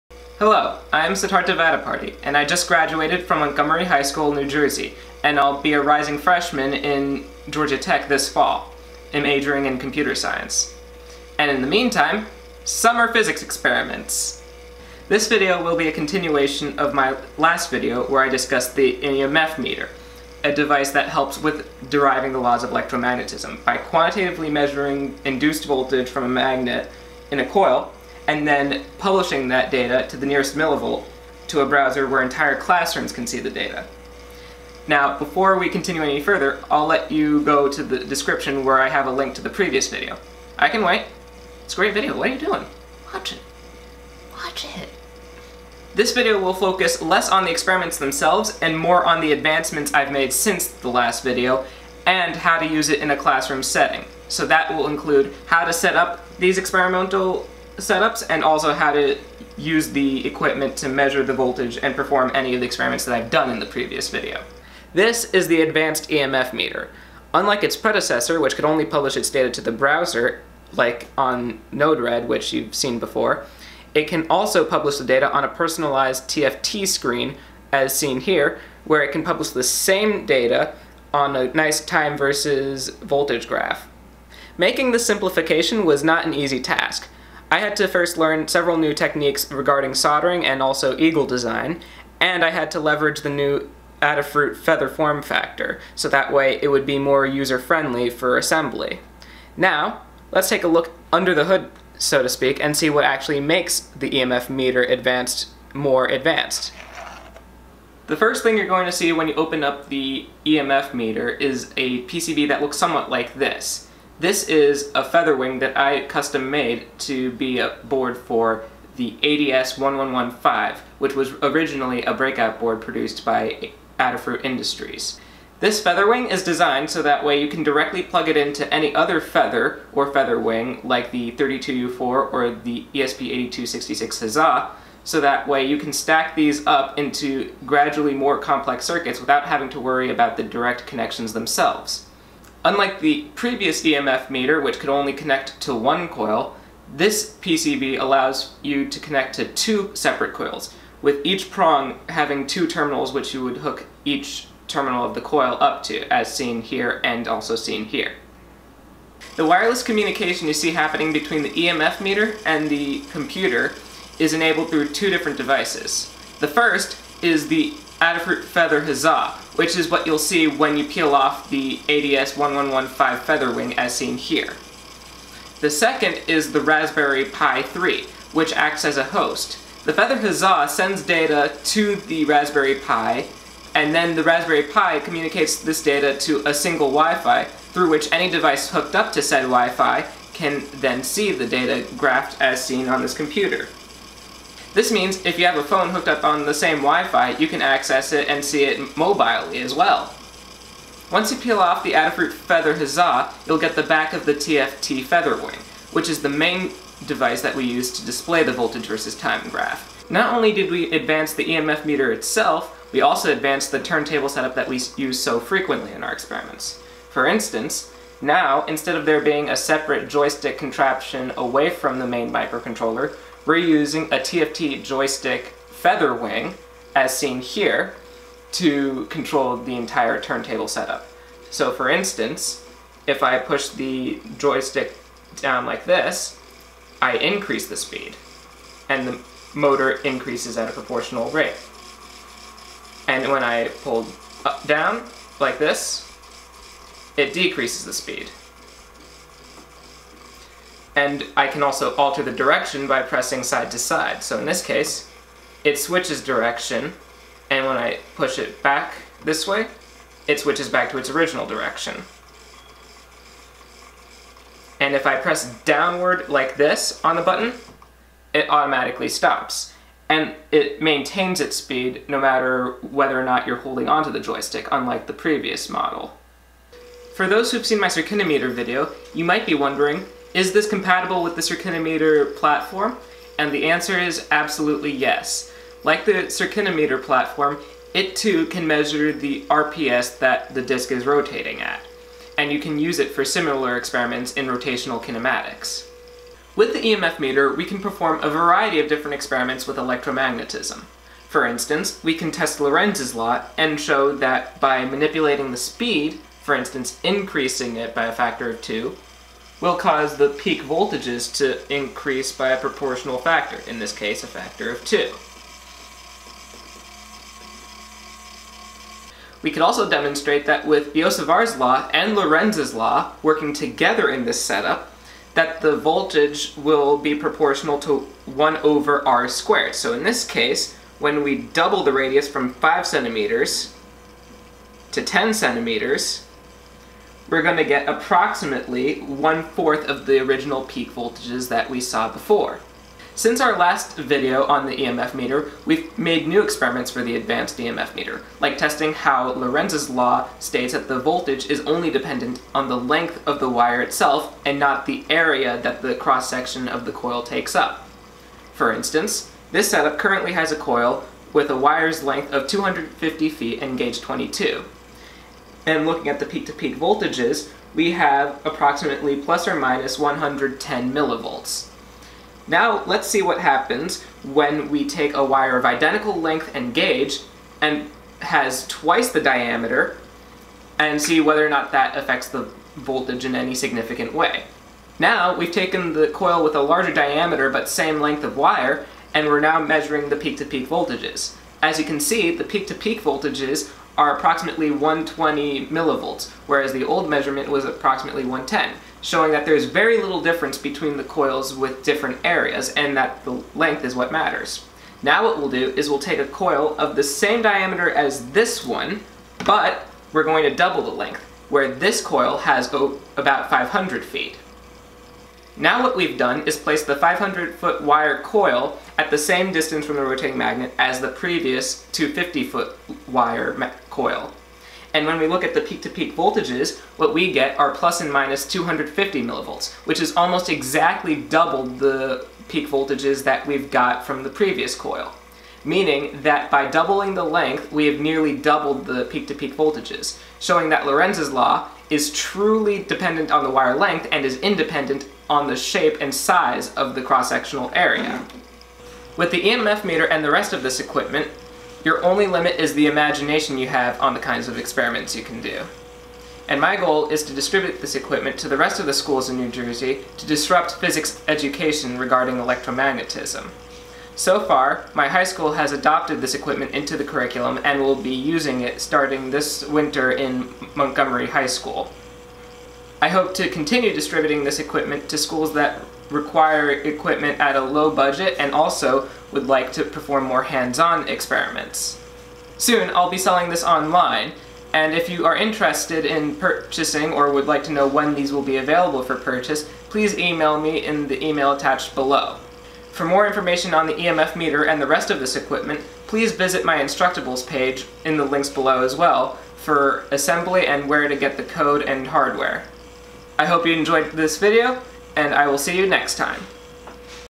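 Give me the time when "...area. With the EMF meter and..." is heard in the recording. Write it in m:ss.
7:27.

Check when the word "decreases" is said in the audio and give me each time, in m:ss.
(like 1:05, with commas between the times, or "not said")
4:07.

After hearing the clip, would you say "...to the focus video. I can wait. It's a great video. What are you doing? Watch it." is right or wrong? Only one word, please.
wrong.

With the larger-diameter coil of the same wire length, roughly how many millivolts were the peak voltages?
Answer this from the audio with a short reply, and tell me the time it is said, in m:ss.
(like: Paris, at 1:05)
120 millivolts, at 6:34.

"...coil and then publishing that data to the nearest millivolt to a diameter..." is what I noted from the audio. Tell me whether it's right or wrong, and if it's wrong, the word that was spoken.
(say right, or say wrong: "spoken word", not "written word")
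wrong: "browser", not "diameter".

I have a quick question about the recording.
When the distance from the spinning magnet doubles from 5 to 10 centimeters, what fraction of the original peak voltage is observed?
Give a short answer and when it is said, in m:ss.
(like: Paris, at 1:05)
one-fourth, at 5:38.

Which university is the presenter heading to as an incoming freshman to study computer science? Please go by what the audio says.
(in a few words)
Georgia Tech.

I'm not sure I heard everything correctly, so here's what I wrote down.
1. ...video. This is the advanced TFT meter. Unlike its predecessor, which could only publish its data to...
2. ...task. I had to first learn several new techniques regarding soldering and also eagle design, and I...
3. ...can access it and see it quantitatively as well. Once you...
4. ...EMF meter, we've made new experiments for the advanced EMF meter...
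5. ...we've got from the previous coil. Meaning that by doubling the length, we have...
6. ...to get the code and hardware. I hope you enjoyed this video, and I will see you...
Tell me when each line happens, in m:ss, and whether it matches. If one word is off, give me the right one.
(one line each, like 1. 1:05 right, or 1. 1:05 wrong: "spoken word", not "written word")
1. 1:04 wrong: "EMF", not "TFT"
2. 1:26 right
3. 3:17 wrong: "mobilely", not "quantitatively"
4. 5:44 right
5. 7:13 right
6. 8:21 right.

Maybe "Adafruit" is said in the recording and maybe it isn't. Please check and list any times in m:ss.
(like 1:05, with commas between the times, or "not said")
1:34, 2:03, 2:48, 3:21.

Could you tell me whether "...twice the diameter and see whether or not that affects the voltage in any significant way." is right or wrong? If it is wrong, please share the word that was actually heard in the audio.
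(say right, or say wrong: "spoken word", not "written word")
right.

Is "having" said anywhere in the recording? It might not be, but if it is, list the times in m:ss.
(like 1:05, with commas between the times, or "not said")
2:19, 2:32.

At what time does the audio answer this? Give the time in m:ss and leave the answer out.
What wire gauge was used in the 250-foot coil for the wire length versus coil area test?
6:04.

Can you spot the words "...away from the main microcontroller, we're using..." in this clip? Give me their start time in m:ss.
3:41.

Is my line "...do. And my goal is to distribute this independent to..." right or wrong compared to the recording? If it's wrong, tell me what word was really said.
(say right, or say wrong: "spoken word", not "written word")
wrong: "equipment", not "independent".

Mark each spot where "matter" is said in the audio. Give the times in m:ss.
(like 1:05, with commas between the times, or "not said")
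4:32, 6:44.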